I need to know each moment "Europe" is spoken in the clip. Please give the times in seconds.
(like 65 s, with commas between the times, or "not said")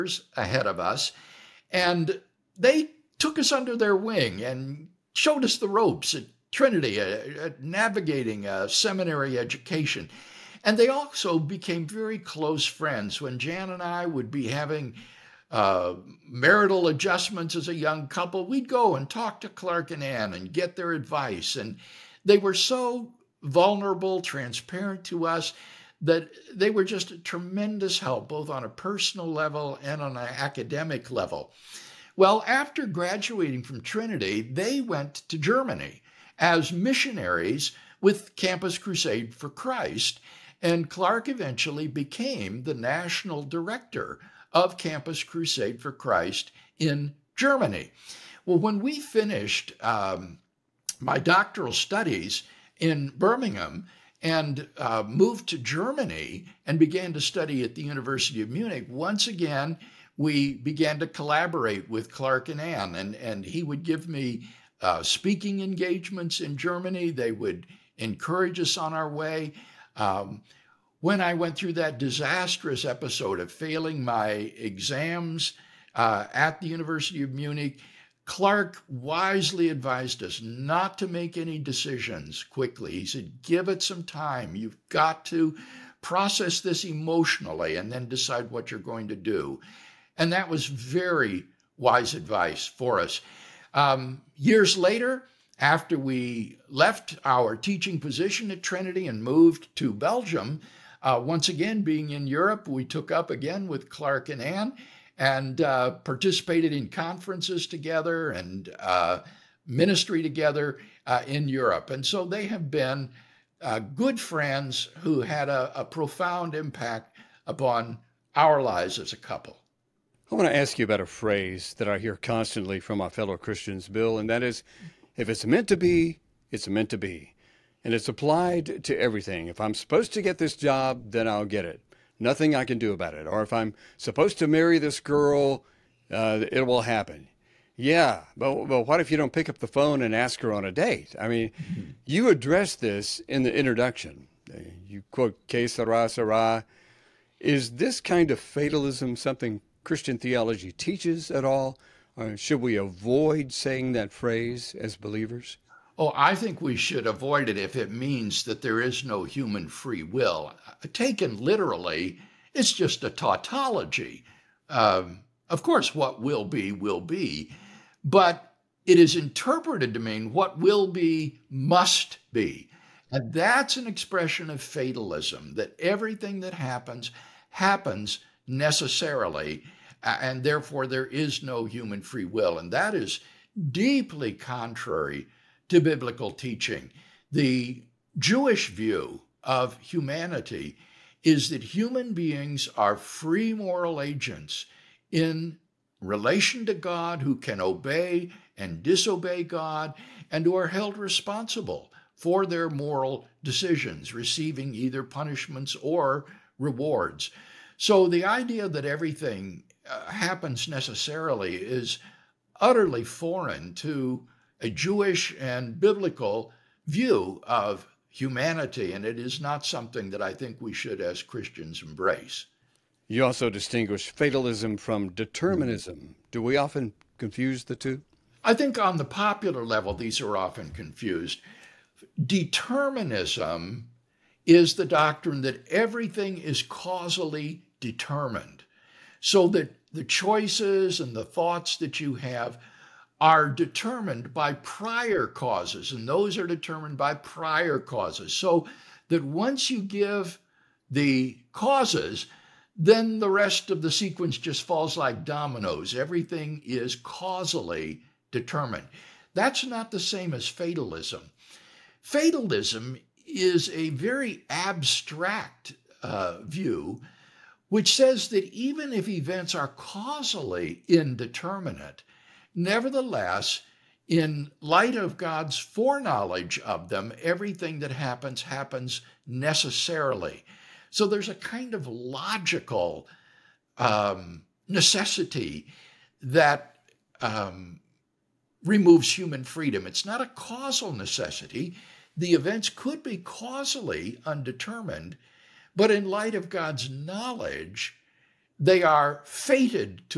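102 s, 111 s.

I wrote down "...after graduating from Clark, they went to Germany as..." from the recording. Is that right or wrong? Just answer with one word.
wrong.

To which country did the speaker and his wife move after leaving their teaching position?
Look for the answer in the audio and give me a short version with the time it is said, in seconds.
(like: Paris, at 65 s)
Belgium, at 99 s.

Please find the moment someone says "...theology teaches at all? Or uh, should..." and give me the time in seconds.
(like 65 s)
150 s.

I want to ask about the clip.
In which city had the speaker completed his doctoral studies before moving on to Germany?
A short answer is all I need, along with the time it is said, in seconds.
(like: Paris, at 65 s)
Birmingham, at 53 s.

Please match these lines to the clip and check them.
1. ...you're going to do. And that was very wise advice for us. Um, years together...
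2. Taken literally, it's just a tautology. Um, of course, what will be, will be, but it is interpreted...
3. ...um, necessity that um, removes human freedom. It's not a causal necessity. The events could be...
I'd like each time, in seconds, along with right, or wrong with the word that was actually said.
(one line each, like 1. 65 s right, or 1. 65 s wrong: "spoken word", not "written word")
1. 88 s wrong: "later", not "together"
2. 160 s right
3. 283 s right.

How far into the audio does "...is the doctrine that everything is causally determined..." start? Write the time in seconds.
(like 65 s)
234 s.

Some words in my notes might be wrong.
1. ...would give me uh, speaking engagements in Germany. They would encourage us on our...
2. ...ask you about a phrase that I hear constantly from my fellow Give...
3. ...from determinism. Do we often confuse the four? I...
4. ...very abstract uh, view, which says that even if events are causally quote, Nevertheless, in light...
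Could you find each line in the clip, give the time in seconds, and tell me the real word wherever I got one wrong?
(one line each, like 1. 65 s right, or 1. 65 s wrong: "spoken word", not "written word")
1. 63 s right
2. 120 s wrong: "Christians", not "Give"
3. 224 s wrong: "two", not "four"
4. 263 s wrong: "indeterminate", not "quote".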